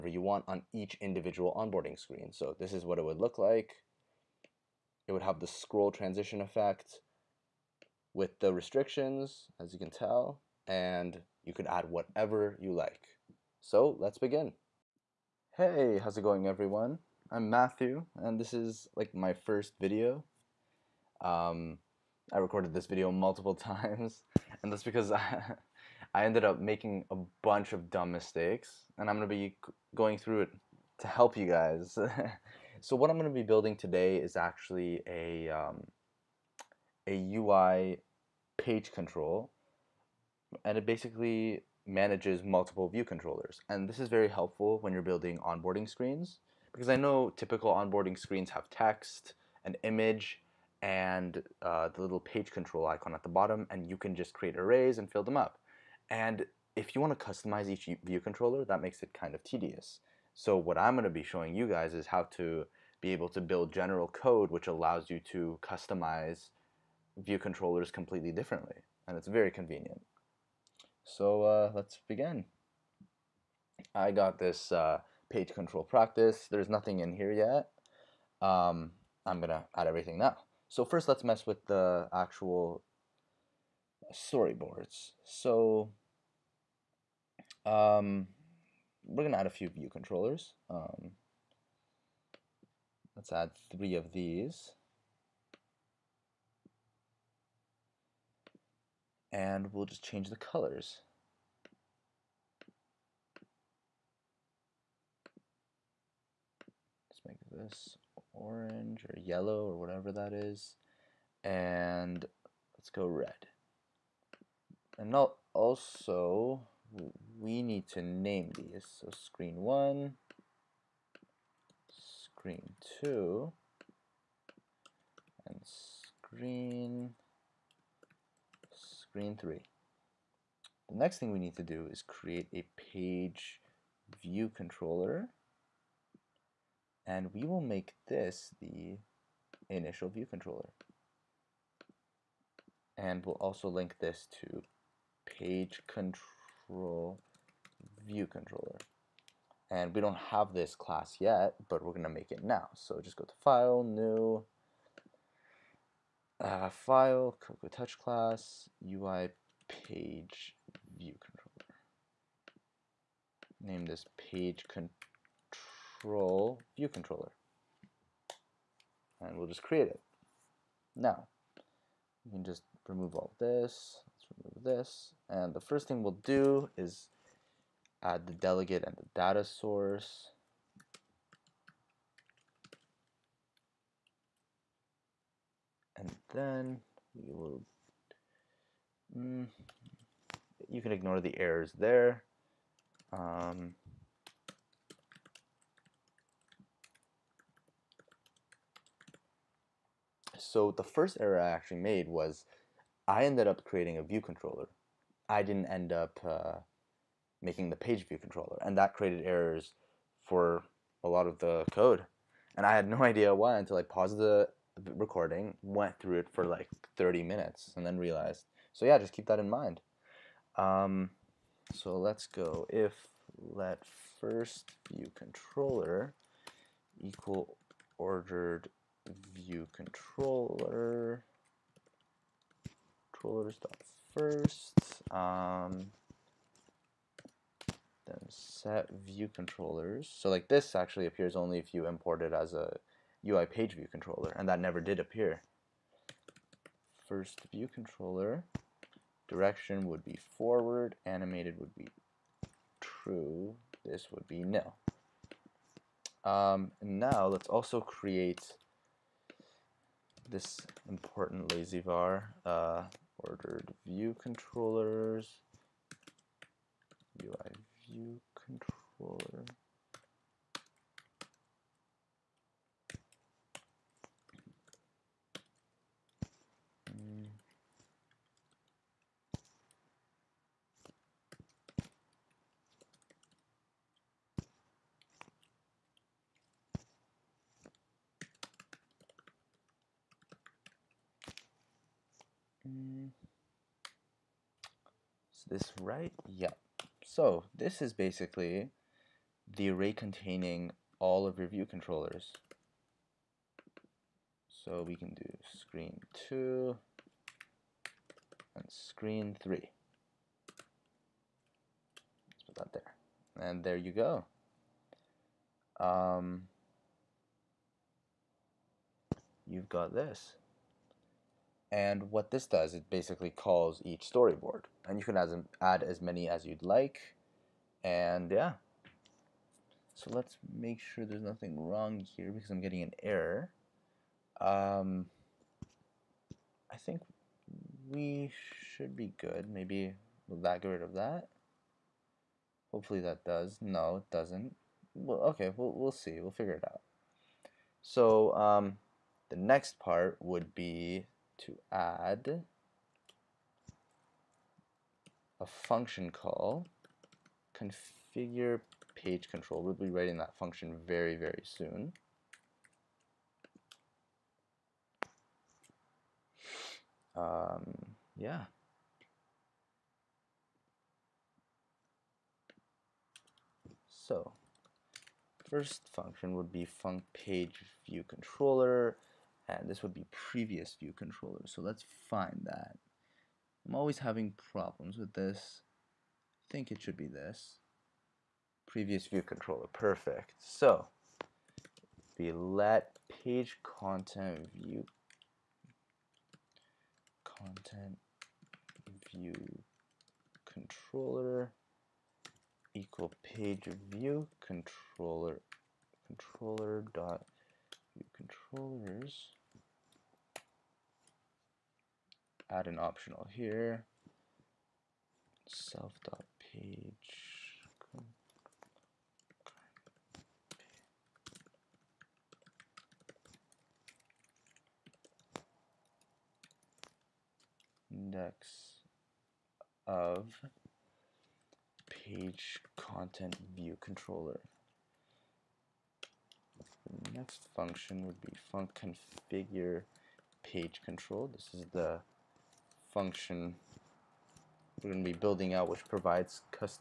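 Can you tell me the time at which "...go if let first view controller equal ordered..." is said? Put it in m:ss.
3:42.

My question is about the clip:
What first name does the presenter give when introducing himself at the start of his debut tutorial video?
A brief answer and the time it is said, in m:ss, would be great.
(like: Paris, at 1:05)
Mathew, at 0:17.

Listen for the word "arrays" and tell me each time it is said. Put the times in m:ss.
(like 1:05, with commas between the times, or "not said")
0:54, 4:59.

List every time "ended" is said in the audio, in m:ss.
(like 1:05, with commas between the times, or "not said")
0:26, 3:23.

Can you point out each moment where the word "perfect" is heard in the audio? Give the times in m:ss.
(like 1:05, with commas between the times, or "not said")
6:29.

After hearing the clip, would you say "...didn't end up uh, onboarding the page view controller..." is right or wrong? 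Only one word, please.
wrong.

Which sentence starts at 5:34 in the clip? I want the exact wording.
Um, I think we should be good.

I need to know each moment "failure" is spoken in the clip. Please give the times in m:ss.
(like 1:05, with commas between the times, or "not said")
not said.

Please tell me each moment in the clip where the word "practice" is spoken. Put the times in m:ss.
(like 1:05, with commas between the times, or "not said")
1:15.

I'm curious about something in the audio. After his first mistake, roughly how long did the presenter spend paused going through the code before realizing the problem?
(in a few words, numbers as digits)
30 minutes.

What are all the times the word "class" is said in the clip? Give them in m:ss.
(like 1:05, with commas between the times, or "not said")
2:30, 2:37.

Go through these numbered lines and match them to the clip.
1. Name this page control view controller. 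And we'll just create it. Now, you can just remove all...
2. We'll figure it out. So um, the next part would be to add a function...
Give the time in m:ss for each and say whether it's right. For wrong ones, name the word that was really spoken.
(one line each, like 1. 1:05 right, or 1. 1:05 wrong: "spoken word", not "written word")
1. 2:43 right
2. 5:46 right.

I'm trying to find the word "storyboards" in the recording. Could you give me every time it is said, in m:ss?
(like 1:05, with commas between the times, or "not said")
1:24, 5:24.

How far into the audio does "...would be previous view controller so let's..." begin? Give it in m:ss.
6:19.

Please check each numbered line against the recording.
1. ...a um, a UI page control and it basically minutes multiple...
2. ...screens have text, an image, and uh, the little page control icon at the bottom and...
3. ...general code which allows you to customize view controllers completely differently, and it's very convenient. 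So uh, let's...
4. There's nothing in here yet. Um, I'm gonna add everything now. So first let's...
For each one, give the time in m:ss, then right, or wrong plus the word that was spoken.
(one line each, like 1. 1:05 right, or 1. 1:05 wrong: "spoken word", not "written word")
1. 0:35 wrong: "manages", not "minutes"
2. 0:48 right
3. 1:03 right
4. 1:16 right.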